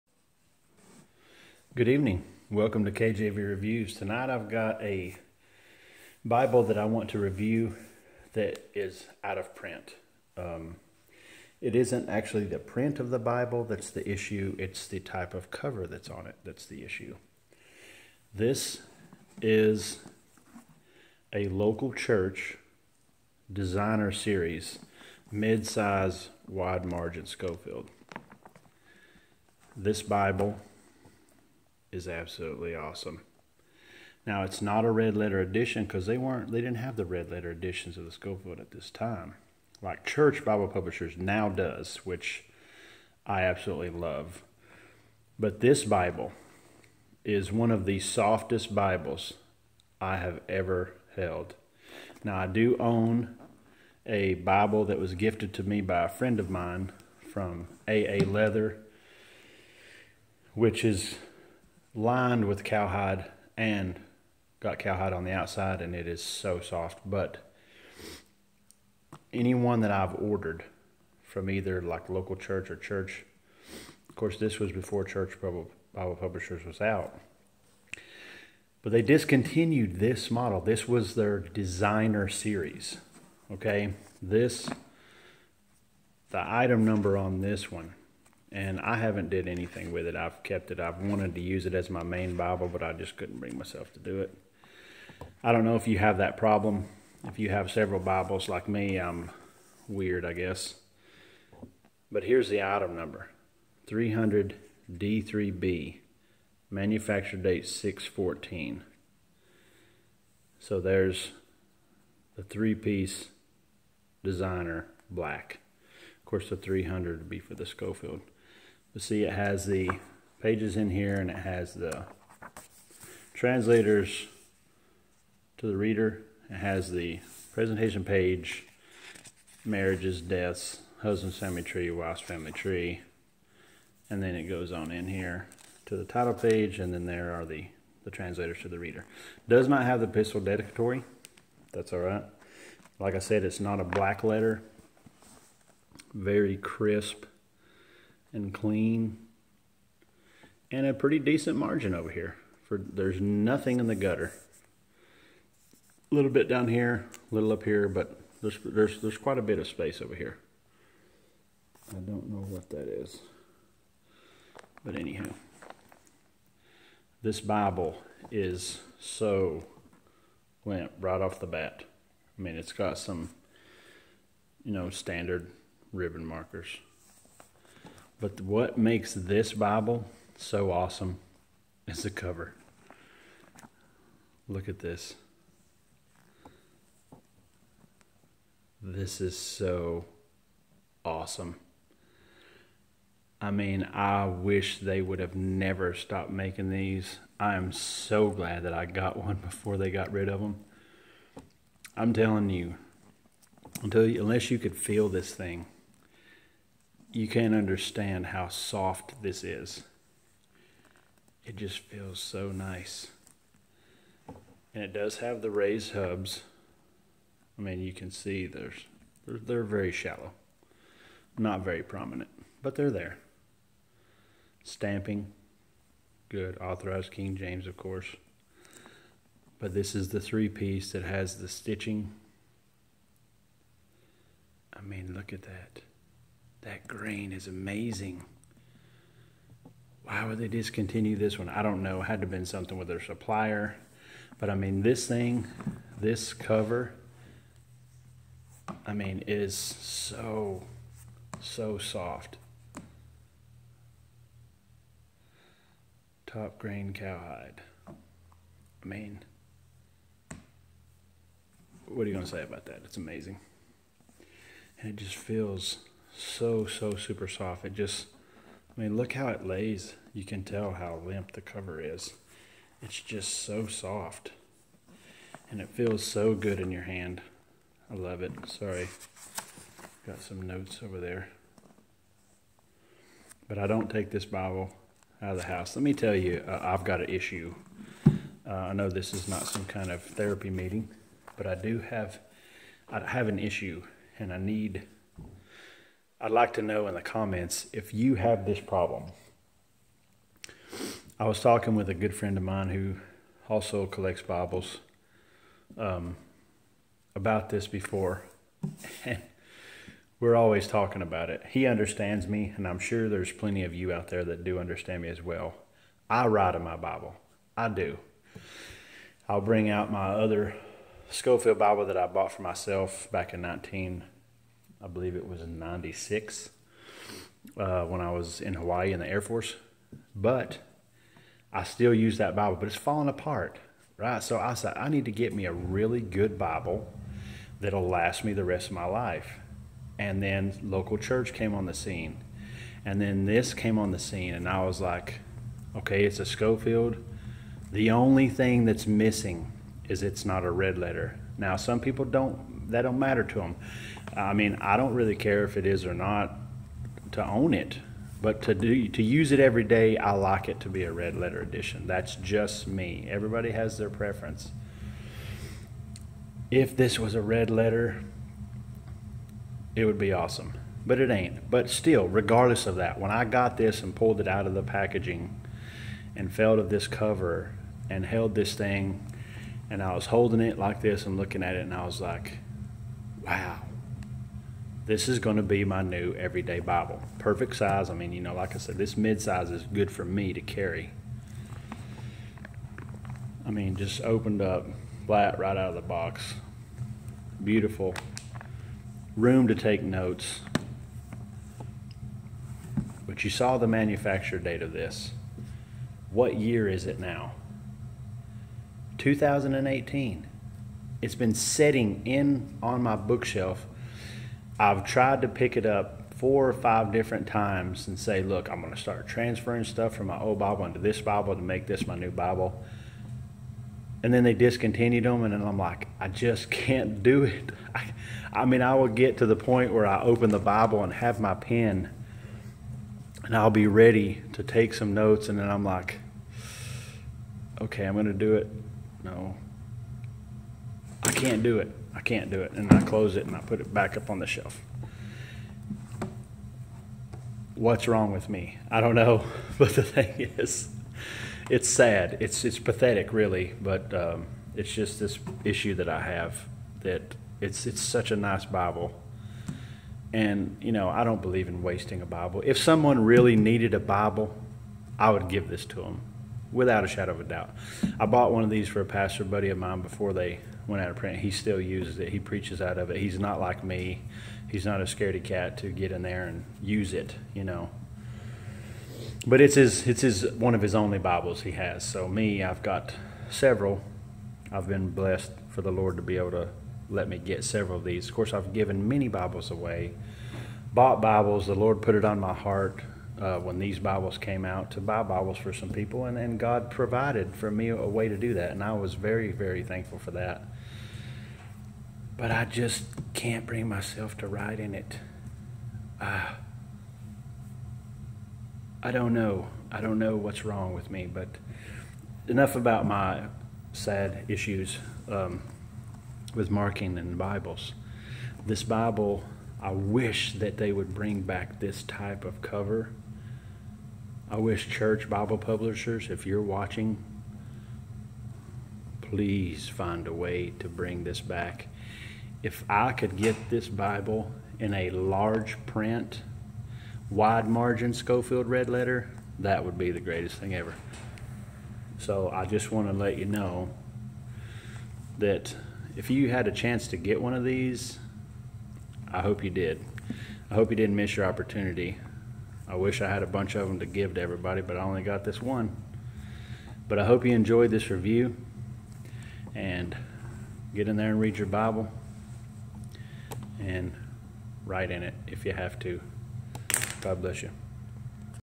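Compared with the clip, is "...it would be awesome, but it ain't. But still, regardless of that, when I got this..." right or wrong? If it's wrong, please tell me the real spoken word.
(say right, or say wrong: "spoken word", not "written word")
right.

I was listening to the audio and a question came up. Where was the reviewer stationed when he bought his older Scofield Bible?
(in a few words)
Hawaii.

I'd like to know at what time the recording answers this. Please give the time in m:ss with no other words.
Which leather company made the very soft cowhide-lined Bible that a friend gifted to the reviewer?
0:57.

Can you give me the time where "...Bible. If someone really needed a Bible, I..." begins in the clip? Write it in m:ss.
7:42.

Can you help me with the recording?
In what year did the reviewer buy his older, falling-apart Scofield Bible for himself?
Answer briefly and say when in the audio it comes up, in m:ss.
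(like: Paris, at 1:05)
1996, at 5:25.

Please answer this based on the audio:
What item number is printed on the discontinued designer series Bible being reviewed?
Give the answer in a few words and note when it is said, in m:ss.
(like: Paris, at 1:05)
300 D3B, at 1:43.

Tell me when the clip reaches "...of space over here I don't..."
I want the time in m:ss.
2:39.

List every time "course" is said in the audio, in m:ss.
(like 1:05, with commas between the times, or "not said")
1:14, 1:56, 3:47, 8:08.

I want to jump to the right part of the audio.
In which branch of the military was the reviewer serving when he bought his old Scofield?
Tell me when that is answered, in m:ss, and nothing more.
5:29.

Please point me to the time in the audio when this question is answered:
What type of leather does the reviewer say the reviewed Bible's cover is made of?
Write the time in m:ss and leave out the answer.
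4:16.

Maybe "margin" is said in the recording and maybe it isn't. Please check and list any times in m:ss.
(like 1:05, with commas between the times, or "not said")
0:26, 2:31, 8:57.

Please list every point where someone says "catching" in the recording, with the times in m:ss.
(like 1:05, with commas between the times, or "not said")
not said.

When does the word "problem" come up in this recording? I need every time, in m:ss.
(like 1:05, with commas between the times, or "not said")
1:36, 4:58.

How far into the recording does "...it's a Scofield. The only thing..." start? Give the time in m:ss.
5:46.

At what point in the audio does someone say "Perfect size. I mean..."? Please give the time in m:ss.
6:27.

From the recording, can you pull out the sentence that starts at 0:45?
But this Bible is one of the softest Bibles I have ever held.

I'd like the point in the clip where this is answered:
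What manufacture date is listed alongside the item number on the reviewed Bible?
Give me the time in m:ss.
1:47.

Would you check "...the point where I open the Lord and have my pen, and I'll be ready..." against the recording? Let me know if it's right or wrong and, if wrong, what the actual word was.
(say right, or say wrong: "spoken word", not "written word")
wrong: "Bible", not "Lord".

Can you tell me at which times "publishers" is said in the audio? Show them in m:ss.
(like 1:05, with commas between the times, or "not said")
0:40, 1:16, 8:45.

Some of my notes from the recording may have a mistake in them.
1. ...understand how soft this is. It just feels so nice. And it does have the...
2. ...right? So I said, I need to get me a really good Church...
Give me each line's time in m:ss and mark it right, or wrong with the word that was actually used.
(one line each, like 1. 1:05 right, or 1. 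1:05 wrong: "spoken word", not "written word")
1. 3:27 right
2. 5:33 wrong: "Bible", not "Church".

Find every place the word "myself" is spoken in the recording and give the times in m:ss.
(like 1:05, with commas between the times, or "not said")
1:33, 5:22, 8:23.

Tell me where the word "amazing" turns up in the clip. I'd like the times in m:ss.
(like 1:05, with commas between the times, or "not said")
3:57, 4:22.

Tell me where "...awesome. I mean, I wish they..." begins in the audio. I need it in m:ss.
3:11.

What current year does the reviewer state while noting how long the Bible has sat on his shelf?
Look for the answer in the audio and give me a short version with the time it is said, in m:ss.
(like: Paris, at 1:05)
2018, at 6:48.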